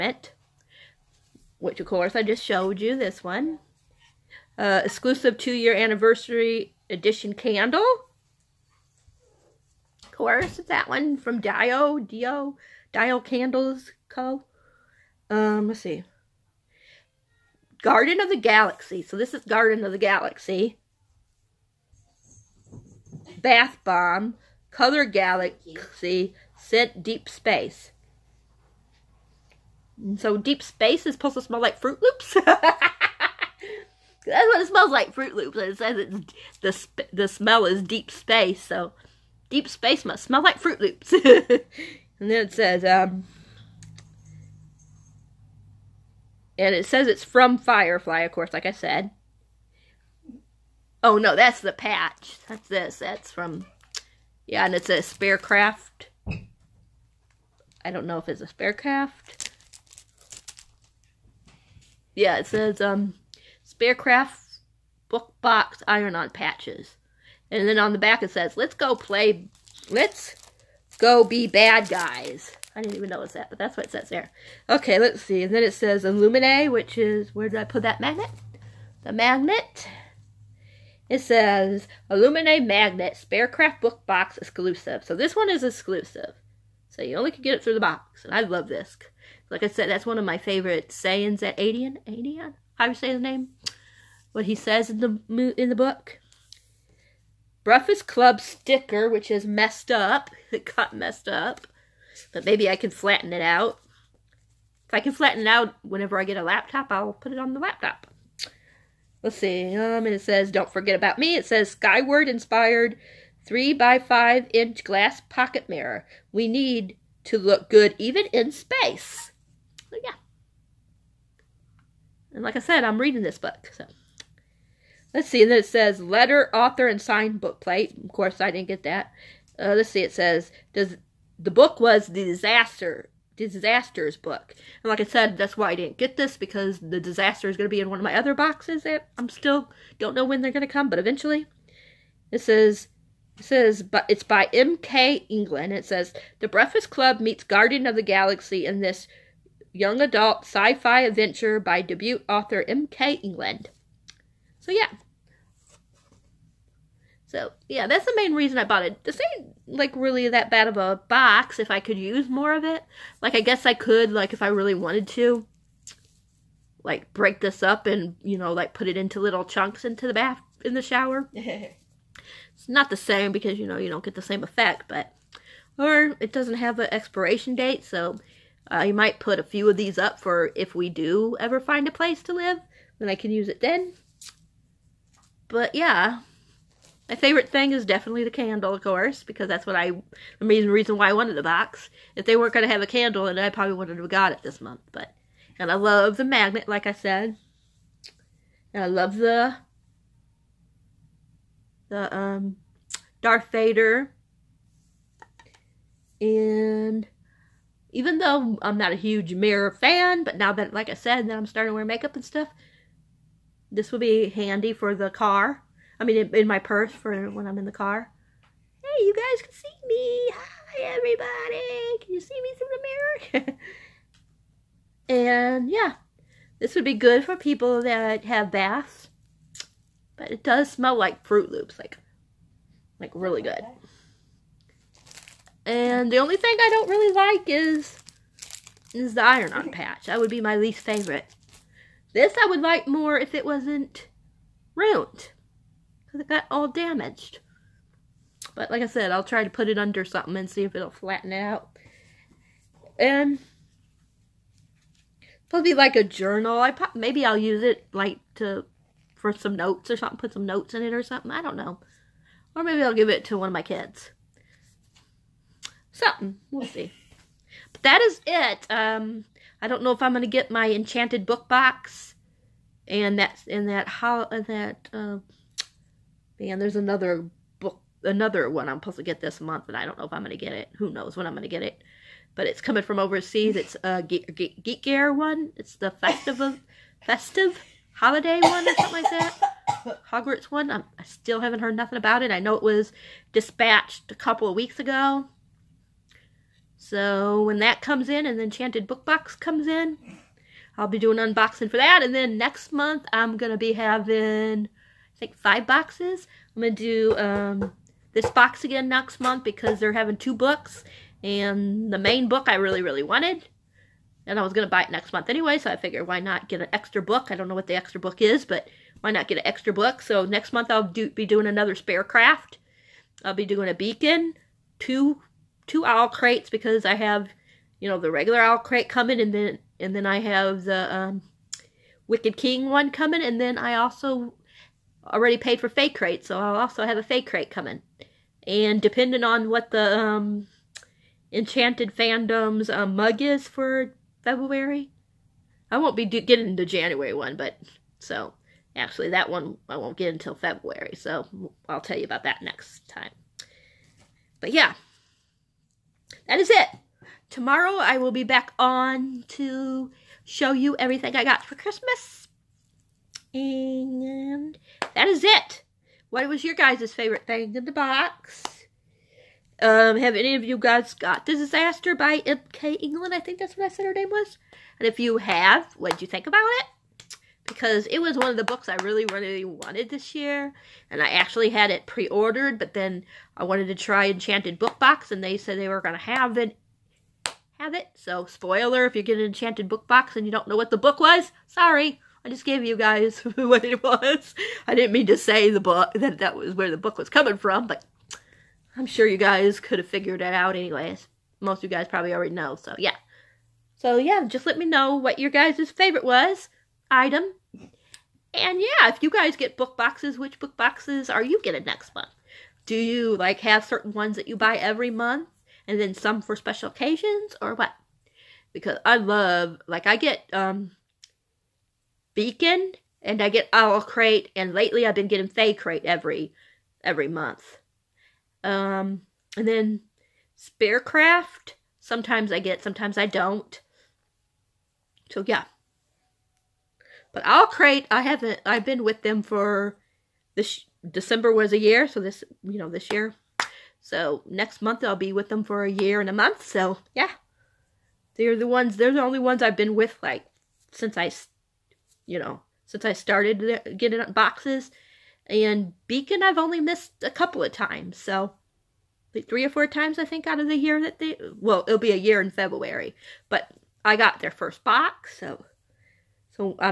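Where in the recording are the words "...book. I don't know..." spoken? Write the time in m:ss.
5:17.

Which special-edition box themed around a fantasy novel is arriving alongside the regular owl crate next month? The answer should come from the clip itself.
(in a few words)
Wicked King.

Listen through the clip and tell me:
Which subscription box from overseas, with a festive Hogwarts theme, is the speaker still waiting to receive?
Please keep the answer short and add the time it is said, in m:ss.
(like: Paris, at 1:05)
Geek Gear, at 4:44.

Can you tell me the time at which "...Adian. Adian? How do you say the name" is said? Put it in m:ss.
1:31.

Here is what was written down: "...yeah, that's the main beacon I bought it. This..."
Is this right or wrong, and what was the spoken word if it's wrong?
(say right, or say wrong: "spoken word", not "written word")
wrong: "reason", not "beacon".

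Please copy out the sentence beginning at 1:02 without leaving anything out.
Yeah, it says um Spearcraft book box iron on patches.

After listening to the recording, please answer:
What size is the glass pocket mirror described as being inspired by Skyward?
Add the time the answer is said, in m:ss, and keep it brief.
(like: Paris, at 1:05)
3 by 5 inch, at 1:53.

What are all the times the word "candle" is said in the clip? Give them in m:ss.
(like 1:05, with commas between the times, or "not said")
0:07, 0:13, 3:08, 3:12.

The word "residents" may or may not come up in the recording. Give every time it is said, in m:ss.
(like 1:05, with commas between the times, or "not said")
not said.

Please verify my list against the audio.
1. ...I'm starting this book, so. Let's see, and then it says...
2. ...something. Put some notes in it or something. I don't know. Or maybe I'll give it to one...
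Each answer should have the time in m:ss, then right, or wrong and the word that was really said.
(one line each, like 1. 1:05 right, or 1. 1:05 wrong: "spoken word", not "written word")
1. 2:02 wrong: "reading", not "starting"
2. 4:19 right.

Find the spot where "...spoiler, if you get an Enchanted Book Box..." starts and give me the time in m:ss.
6:28.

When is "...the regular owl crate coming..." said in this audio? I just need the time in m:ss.
5:27.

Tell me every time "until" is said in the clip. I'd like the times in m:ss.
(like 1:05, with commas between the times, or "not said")
5:50.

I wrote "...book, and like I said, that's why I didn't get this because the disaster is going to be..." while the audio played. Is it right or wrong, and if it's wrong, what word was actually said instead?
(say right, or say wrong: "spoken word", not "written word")
right.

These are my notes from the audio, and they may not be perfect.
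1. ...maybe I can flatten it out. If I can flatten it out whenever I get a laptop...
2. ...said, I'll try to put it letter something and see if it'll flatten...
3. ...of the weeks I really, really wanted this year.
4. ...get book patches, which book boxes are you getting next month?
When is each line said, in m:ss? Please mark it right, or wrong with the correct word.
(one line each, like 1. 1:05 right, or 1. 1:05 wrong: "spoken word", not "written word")
1. 1:42 right
2. 4:08 wrong: "under", not "letter"
3. 6:18 wrong: "books", not "weeks"
4. 6:49 wrong: "boxes", not "patches".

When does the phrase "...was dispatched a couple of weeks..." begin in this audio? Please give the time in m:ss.
4:52.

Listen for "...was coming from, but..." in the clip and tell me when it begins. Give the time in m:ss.
6:36.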